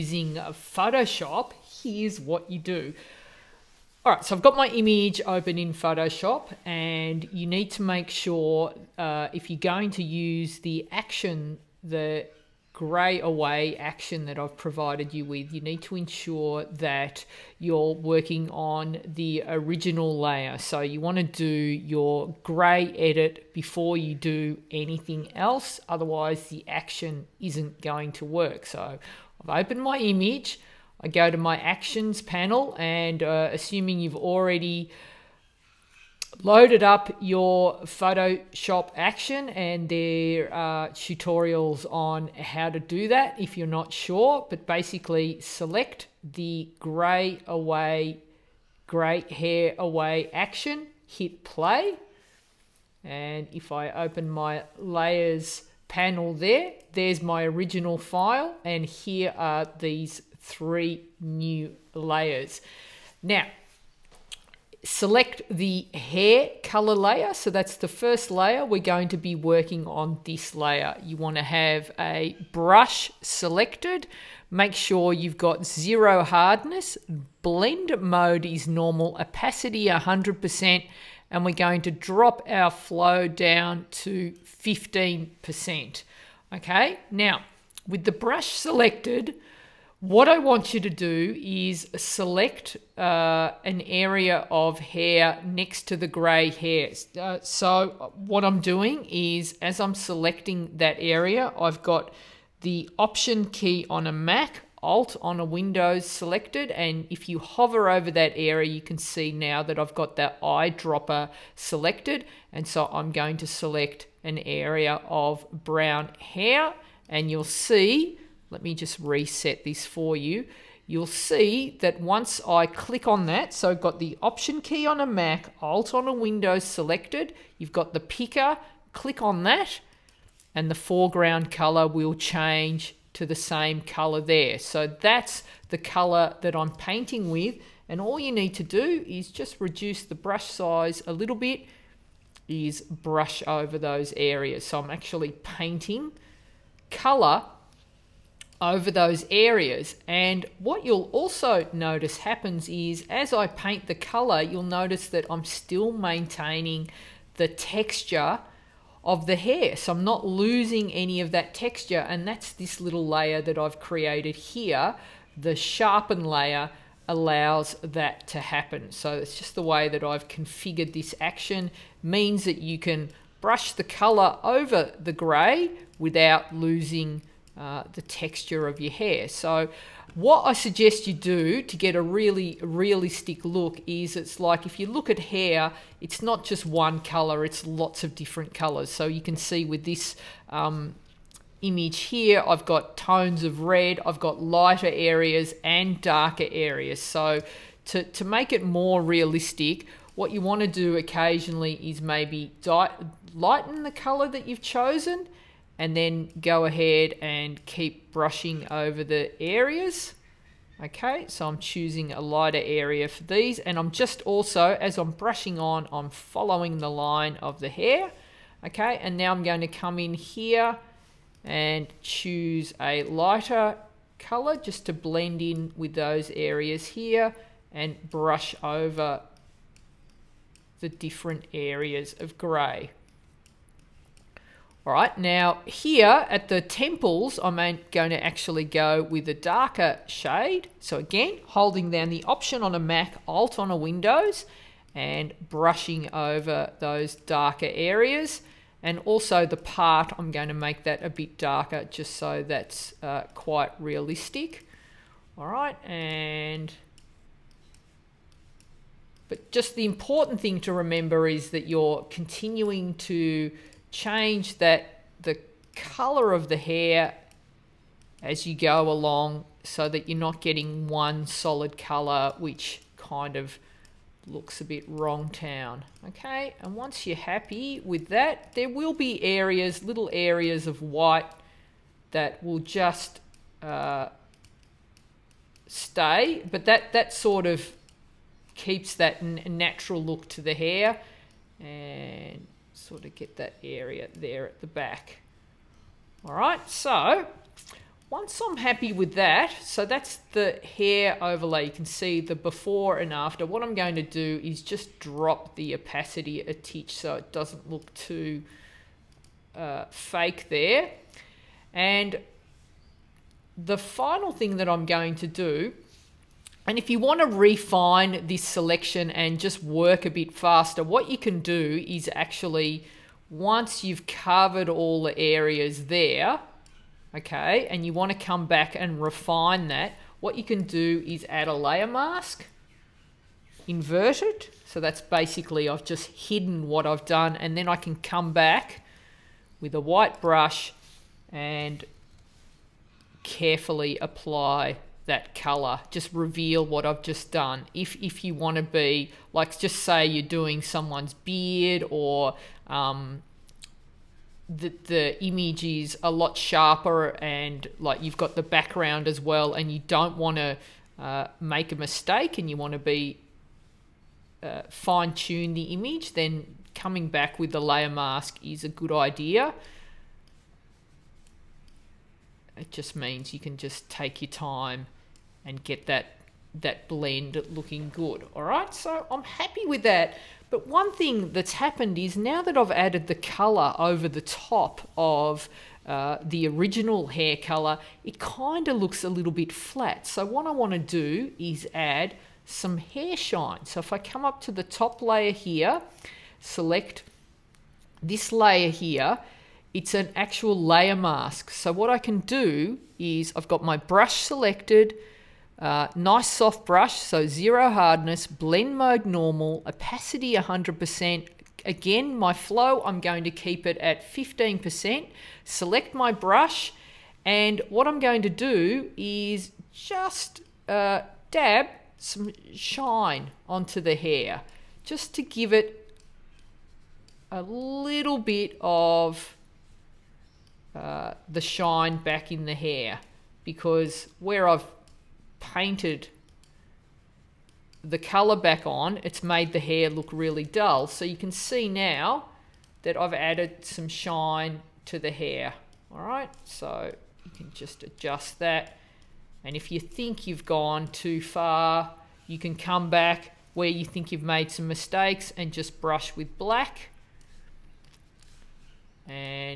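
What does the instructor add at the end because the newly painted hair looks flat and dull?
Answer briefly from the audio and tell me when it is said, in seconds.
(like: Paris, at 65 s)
Hair shine, at 392 s.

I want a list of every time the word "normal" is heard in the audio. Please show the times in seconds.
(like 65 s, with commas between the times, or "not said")
78 s, 409 s.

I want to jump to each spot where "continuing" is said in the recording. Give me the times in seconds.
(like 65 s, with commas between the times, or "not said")
262 s.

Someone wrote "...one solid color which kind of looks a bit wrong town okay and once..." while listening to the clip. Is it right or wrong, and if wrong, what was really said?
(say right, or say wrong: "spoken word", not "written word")
right.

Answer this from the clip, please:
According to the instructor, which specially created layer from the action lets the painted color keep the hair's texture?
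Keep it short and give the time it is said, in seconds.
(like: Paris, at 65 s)
The sharpen layer, at 165 s.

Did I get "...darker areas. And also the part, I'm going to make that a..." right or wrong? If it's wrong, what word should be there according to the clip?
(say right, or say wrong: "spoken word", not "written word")
right.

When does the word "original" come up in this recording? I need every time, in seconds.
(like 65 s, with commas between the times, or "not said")
19 s, 57 s, 386 s.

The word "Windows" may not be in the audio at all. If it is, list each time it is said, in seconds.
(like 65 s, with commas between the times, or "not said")
105 s, 126 s, 243 s.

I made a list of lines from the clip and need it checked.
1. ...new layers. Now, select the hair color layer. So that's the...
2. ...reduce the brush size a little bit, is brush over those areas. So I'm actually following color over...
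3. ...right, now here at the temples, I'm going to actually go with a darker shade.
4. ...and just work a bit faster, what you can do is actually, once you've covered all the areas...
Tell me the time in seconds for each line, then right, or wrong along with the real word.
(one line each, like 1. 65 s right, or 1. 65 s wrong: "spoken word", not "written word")
1. 61 s right
2. 139 s wrong: "painting", not "following"
3. 234 s right
4. 319 s right.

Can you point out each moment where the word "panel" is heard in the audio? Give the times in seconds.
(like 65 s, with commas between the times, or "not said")
32 s, 55 s.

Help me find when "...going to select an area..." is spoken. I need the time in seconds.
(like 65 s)
113 s.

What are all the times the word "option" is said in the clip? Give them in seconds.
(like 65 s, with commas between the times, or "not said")
102 s, 124 s, 242 s.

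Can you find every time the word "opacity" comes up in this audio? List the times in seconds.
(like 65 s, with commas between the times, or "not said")
79 s, 305 s, 409 s.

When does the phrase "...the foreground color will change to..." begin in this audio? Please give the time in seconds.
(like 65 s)
130 s.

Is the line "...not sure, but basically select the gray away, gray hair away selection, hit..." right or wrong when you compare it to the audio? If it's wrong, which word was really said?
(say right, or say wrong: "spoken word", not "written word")
wrong: "action", not "selection".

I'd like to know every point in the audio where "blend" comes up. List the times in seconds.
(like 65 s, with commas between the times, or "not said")
77 s, 224 s, 376 s, 408 s.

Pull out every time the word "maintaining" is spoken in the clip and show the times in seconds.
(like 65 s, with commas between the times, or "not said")
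155 s.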